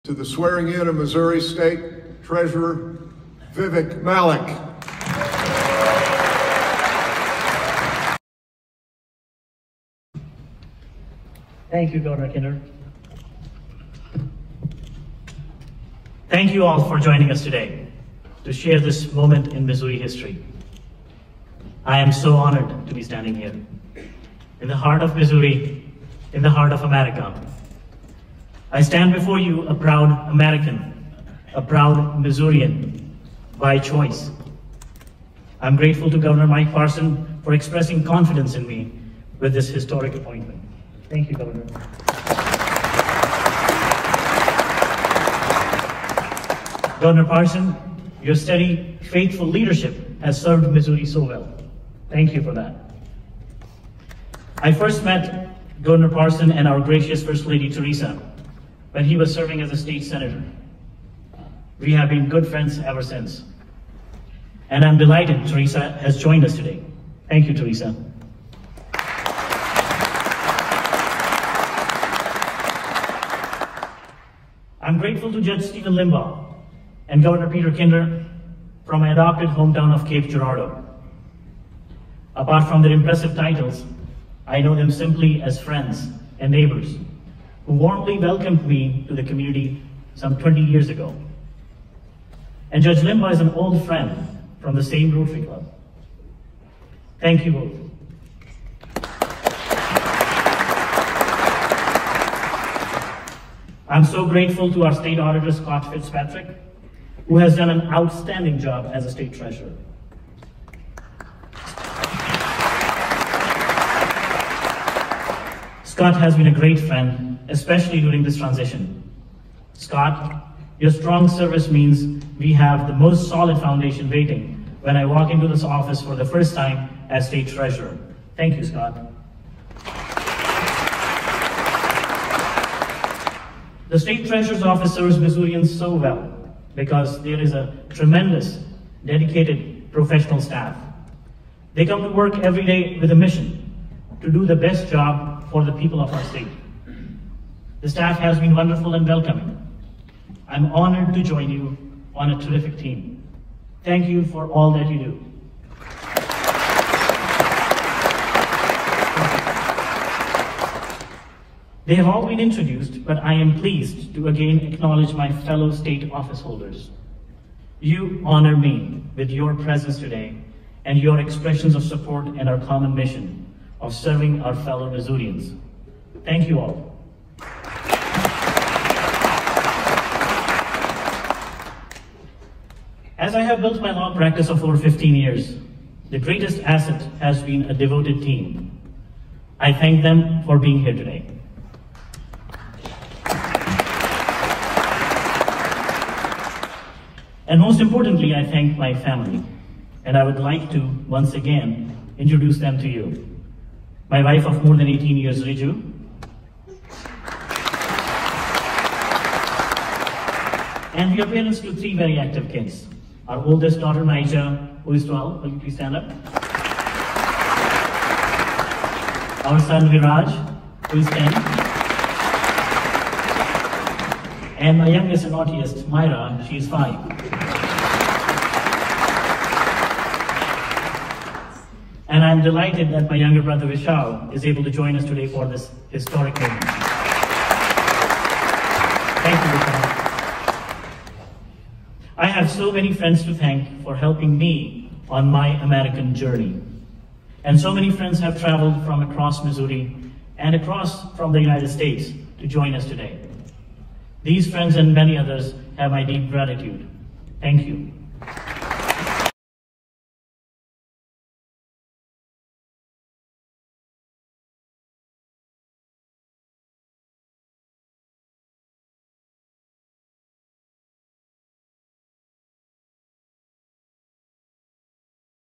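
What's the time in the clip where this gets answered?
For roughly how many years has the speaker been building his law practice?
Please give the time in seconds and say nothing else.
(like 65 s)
184 s.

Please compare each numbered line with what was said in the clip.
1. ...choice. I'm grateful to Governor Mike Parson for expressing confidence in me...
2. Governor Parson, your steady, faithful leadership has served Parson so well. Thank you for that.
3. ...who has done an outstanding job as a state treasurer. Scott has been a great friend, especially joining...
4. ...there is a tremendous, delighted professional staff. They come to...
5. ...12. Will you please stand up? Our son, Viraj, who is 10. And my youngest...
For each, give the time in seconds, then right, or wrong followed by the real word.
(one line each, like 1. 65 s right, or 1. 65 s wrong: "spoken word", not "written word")
1. 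33 s right
2. 47 s wrong: "Missouri", not "Parson"
3. 107 s wrong: "during", not "joining"
4. 137 s wrong: "dedicated", not "delighted"
5. 215 s right.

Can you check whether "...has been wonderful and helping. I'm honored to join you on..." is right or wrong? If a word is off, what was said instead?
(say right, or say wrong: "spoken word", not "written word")
wrong: "welcoming", not "helping".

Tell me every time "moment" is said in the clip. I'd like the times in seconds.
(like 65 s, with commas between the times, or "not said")
19 s, 236 s.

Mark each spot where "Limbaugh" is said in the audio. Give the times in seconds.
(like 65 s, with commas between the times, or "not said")
75 s, 92 s.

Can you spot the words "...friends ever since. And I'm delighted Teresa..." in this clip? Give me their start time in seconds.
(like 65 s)
62 s.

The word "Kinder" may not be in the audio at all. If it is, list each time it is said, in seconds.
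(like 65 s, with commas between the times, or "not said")
12 s, 77 s.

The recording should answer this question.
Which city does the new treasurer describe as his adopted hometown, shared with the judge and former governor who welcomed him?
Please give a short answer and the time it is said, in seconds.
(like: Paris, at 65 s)
Cape Girardeau, at 80 s.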